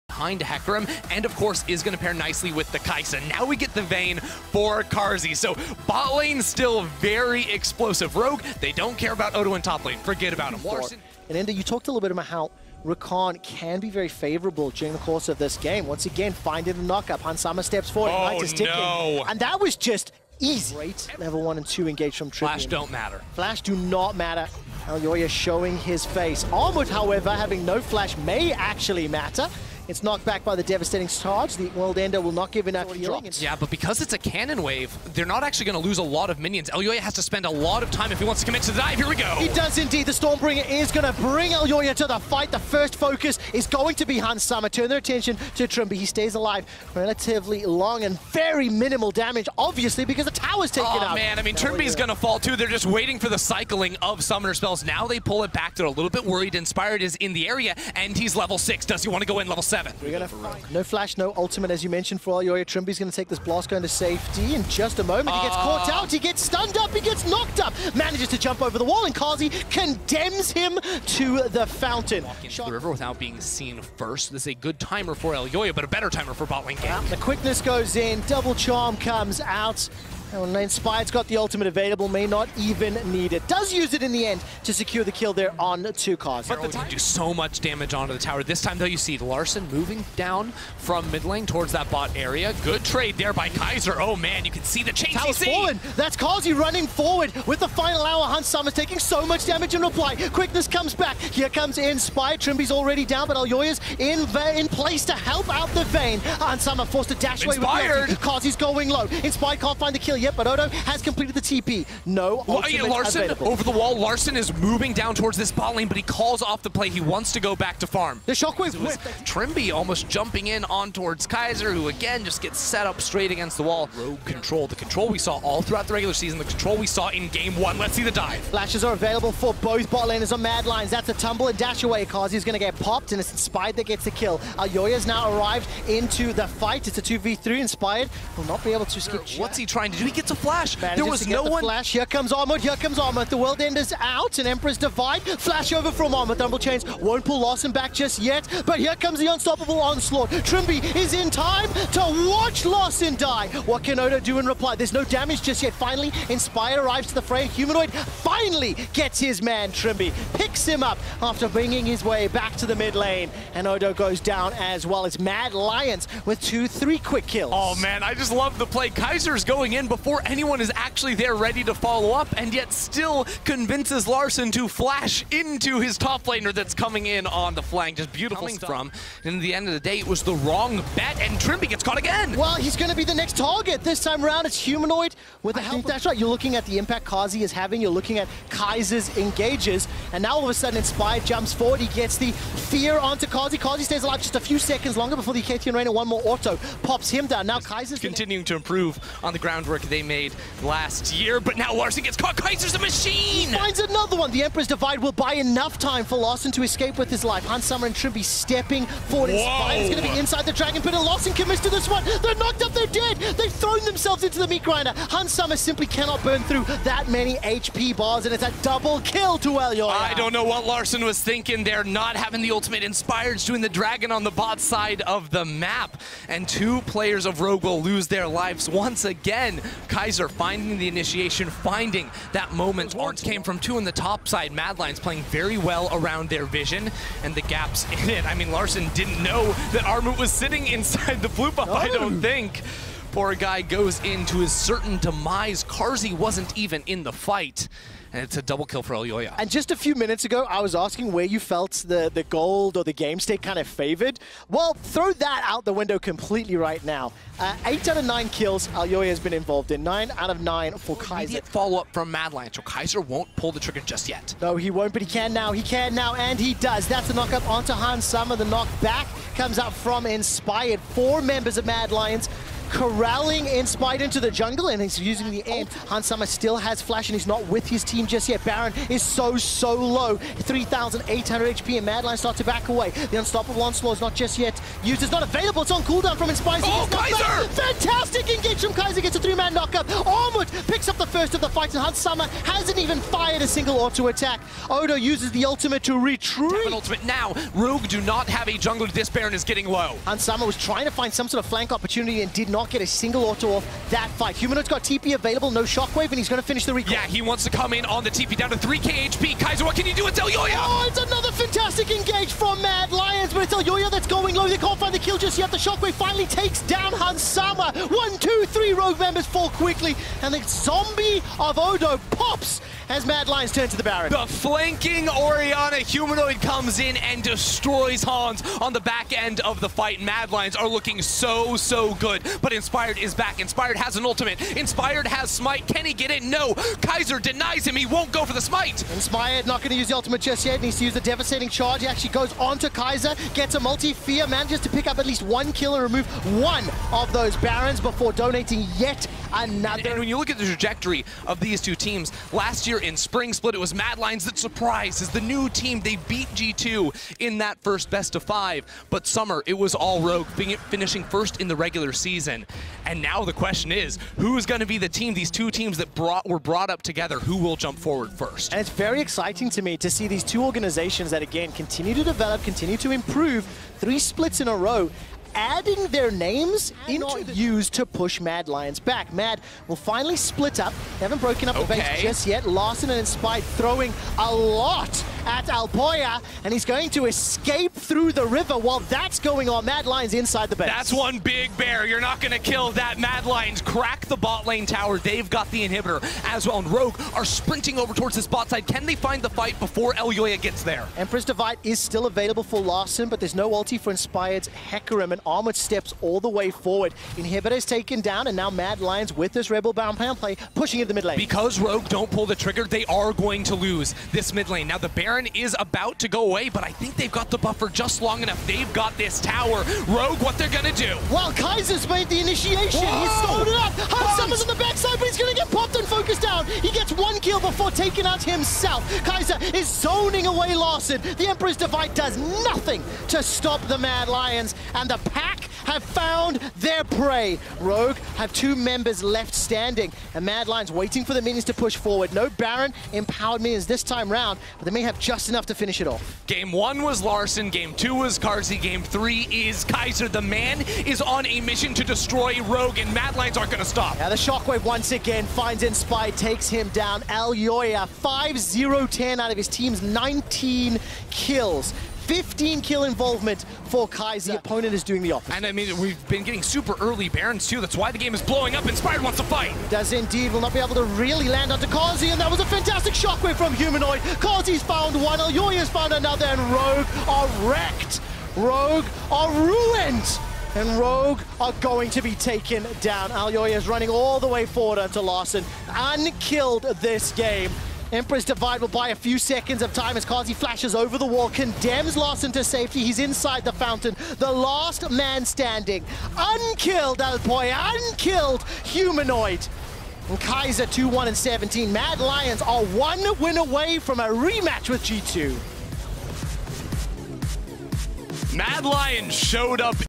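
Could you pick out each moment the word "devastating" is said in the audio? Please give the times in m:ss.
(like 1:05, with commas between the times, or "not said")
0:30, 5:41.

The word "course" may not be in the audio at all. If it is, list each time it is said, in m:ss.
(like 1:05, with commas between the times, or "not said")
0:01, 0:14.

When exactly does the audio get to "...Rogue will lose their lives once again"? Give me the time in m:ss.
3:47.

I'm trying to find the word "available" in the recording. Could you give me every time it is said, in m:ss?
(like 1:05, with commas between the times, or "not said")
1:21, 1:53, 2:08, 4:45, 5:05, 6:42.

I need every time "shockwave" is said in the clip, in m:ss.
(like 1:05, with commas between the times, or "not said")
1:58, 5:05, 5:15, 7:34, 7:52.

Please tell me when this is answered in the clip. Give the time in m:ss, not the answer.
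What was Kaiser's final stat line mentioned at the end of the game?
8:20.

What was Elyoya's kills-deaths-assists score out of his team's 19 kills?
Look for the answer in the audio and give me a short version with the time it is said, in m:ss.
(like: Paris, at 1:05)
5-0-10, at 7:38.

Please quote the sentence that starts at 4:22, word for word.
so Kaiser won't pull the trigger just yet.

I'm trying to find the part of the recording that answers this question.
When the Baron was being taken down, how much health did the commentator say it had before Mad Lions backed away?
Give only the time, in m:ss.
4:40.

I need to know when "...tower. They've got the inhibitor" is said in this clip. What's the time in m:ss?
6:34.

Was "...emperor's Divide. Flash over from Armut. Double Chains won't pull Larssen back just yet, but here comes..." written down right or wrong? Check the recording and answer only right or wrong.
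right.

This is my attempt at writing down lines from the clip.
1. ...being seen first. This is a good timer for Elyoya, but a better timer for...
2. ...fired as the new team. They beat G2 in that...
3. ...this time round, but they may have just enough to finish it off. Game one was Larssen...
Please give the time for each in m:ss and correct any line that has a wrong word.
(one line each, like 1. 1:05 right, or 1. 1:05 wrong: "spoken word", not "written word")
1. 1:13 right
2. 5:54 wrong: "surprised", not "fired"
3. 7:23 right.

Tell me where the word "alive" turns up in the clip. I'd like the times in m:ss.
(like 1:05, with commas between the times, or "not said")
0:46, 3:14.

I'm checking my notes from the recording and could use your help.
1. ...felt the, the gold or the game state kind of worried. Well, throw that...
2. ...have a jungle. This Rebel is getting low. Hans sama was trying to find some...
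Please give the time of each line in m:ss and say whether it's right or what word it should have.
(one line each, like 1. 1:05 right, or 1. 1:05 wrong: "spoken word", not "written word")
1. 4:11 wrong: "favored", not "worried"
2. 4:58 wrong: "Baron", not "Rebel".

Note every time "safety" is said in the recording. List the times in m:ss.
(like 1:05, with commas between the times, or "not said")
1:03, 8:12.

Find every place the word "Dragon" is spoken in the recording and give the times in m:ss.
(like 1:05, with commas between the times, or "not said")
3:30, 3:43.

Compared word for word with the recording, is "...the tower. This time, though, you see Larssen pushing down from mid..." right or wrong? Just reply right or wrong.
wrong.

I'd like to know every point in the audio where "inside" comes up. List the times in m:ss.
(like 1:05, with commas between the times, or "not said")
3:30, 4:00, 6:30, 8:12.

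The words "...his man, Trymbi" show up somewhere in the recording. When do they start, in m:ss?
2:39.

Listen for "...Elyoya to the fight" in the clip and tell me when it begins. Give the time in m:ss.
0:41.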